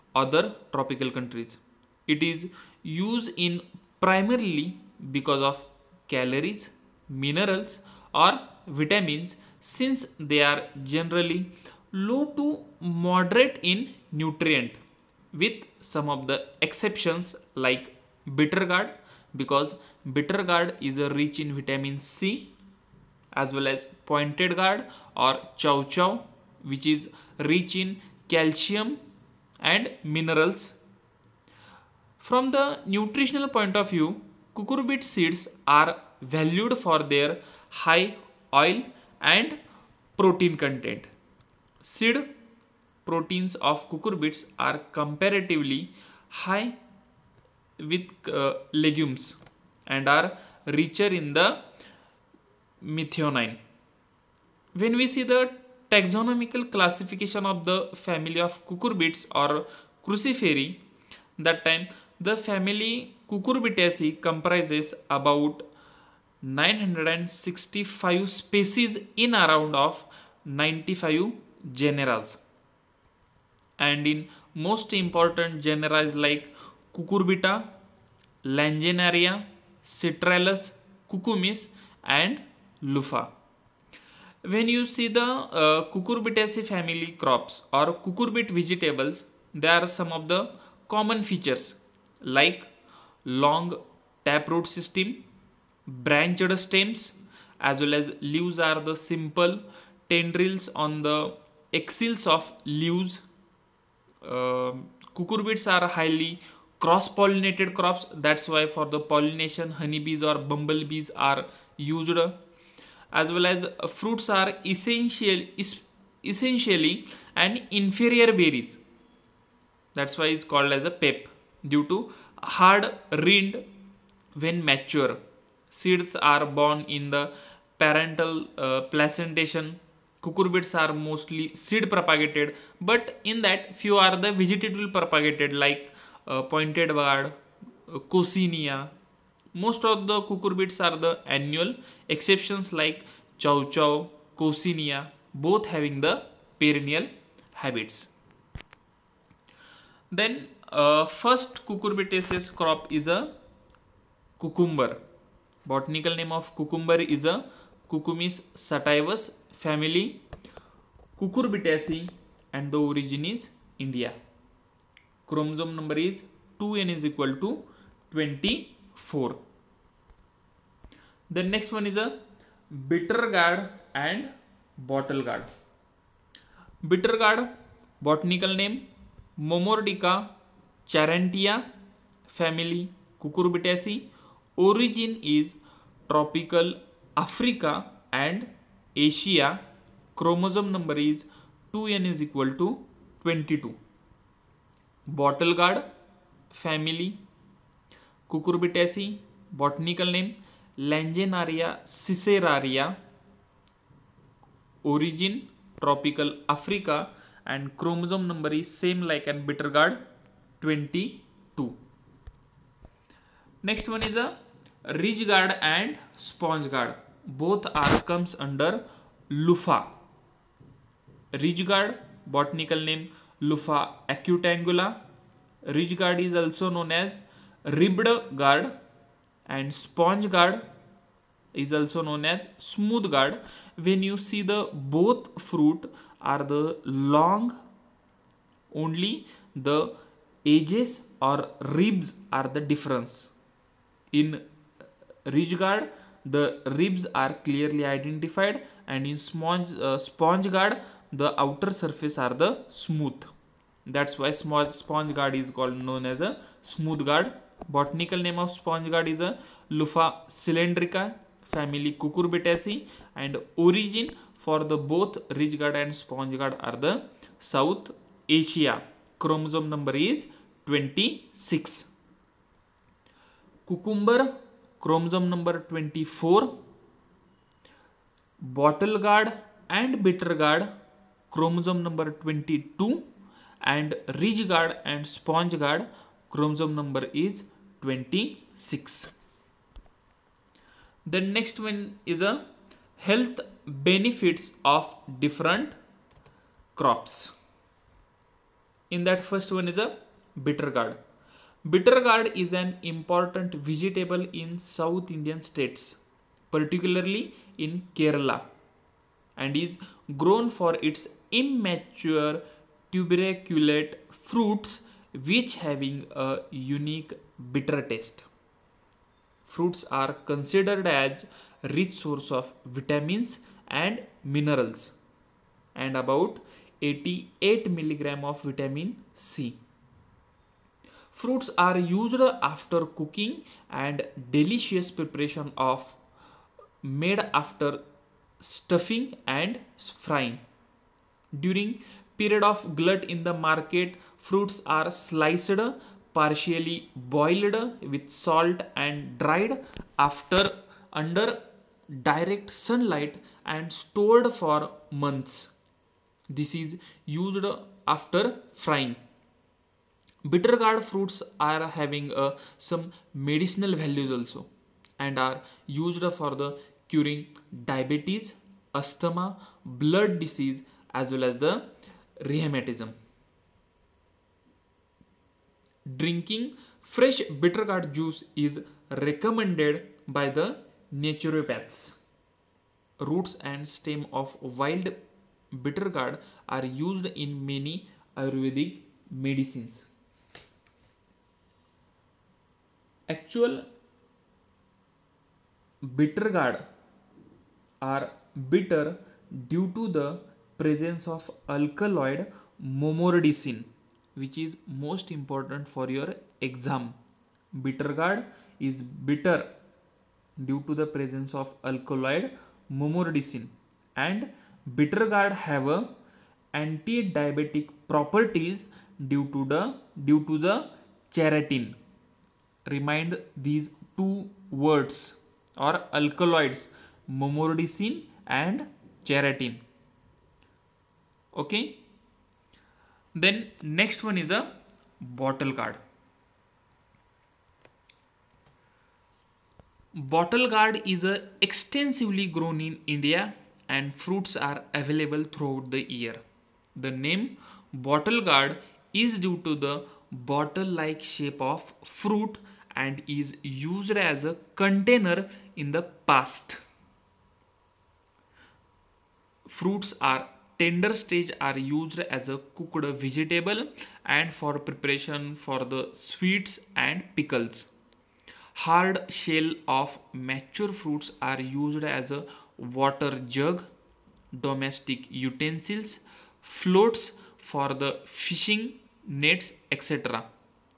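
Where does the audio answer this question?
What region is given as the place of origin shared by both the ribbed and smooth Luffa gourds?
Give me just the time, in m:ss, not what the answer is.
4:27.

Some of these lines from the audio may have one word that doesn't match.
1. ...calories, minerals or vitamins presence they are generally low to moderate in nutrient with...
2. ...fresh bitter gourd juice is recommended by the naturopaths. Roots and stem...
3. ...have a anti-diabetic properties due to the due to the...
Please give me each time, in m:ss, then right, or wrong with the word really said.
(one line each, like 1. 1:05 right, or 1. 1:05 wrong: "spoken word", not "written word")
1. 0:06 wrong: "since", not "presence"
2. 6:16 right
3. 6:55 right.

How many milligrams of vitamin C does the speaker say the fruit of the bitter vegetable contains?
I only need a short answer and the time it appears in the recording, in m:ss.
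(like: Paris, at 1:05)
88 milligrams, at 5:26.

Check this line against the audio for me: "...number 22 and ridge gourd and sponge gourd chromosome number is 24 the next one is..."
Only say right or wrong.
wrong.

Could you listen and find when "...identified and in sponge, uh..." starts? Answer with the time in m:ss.
4:07.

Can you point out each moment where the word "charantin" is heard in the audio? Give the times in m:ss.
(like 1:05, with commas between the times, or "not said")
7:01, 7:09.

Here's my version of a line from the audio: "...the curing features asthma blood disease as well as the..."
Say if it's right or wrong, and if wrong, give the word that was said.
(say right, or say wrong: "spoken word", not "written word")
wrong: "diabetes", not "features".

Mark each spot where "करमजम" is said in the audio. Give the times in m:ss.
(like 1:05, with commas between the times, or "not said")
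3:10, 3:27.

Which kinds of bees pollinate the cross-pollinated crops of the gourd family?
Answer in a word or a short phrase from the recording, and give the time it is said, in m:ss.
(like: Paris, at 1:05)
honeybees or bumblebees, at 1:49.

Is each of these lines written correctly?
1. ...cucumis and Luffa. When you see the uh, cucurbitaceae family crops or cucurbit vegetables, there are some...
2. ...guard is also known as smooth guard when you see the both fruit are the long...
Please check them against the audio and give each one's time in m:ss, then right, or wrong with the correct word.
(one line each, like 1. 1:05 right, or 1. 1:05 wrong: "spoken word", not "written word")
1. 1:21 right
2. 3:50 right.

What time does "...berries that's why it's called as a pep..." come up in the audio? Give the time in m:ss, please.
1:58.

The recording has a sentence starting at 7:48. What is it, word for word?
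Hard shell of mature fruits are used as a water jug, domestic utensils, floats for the fishing, nets, etc.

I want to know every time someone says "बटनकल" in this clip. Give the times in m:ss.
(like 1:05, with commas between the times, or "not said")
2:58, 3:19, 3:42.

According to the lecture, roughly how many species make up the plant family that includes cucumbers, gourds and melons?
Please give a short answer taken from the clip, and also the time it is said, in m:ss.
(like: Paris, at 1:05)
965, at 1:06.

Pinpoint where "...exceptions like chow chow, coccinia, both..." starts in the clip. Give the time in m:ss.
2:22.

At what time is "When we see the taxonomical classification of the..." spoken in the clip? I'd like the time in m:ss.
0:54.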